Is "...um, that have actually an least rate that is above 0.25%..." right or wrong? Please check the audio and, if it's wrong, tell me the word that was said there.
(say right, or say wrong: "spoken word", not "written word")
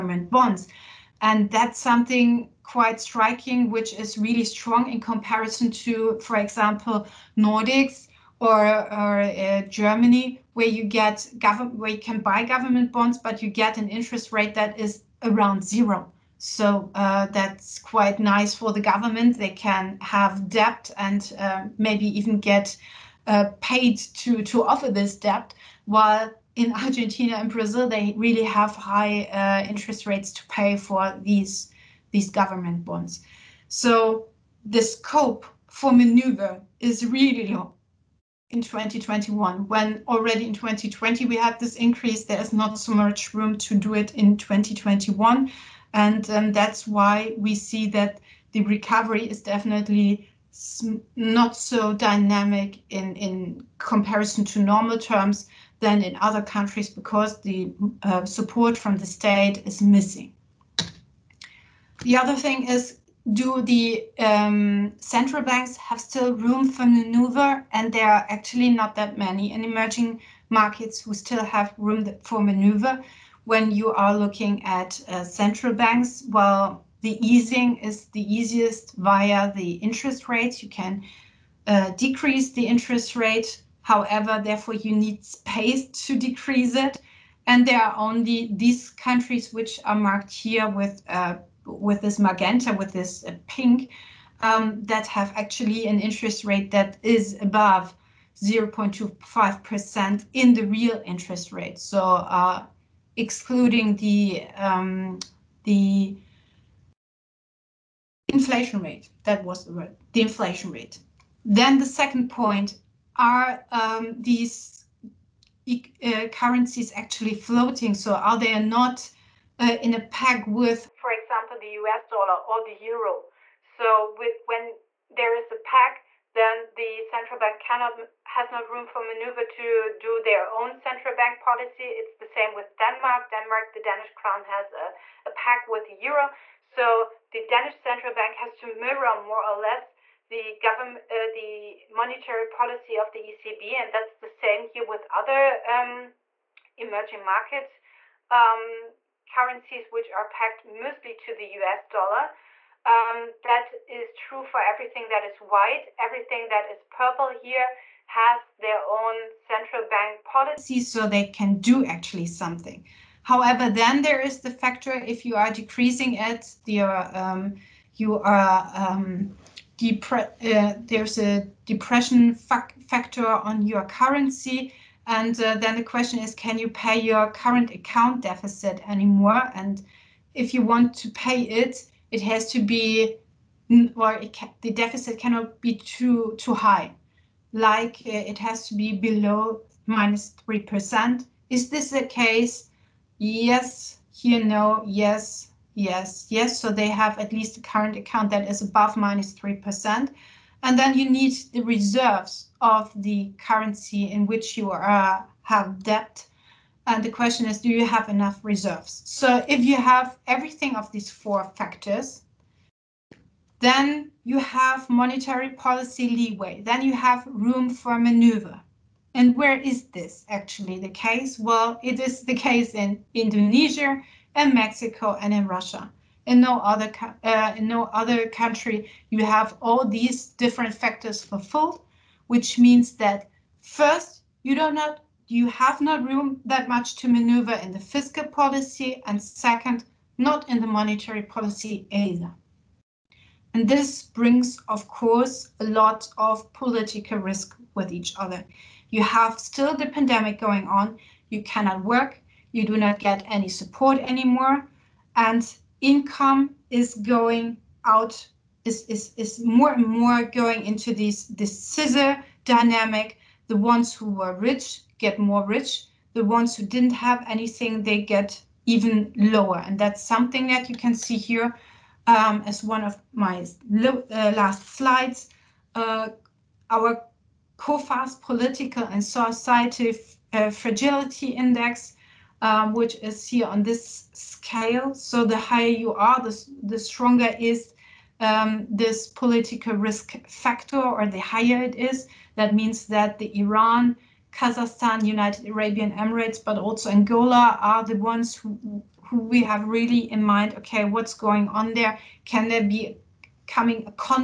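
wrong: "interest", not "least".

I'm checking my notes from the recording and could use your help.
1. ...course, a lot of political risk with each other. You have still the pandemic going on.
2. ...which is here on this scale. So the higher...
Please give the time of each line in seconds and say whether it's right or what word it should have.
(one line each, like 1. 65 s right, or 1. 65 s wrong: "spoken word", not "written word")
1. 244 s right
2. 282 s right.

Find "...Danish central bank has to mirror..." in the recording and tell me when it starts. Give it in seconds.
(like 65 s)
137 s.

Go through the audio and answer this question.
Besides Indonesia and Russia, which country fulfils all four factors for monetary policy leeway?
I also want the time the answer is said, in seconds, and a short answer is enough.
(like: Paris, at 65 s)
Mexico, at 224 s.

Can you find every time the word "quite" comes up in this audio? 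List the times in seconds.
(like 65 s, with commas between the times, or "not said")
2 s, 17 s.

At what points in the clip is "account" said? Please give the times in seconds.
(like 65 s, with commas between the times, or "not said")
177 s, 197 s.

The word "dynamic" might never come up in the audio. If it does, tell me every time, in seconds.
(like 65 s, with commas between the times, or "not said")
51 s, 262 s.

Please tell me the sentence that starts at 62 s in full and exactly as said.
The other thing is, do the um, central banks have still room for maneuver?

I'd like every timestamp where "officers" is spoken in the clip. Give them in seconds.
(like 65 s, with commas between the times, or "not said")
not said.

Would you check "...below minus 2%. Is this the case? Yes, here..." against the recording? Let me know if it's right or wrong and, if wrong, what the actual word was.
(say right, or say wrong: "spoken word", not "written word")
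wrong: "3", not "2".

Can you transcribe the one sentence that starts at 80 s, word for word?
You can uh, decrease the interest rate However, therefore, you need space to decrease it.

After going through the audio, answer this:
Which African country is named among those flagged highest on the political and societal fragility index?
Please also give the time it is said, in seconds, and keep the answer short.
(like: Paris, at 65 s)
Angola, at 296 s.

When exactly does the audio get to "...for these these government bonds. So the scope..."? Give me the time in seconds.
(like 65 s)
30 s.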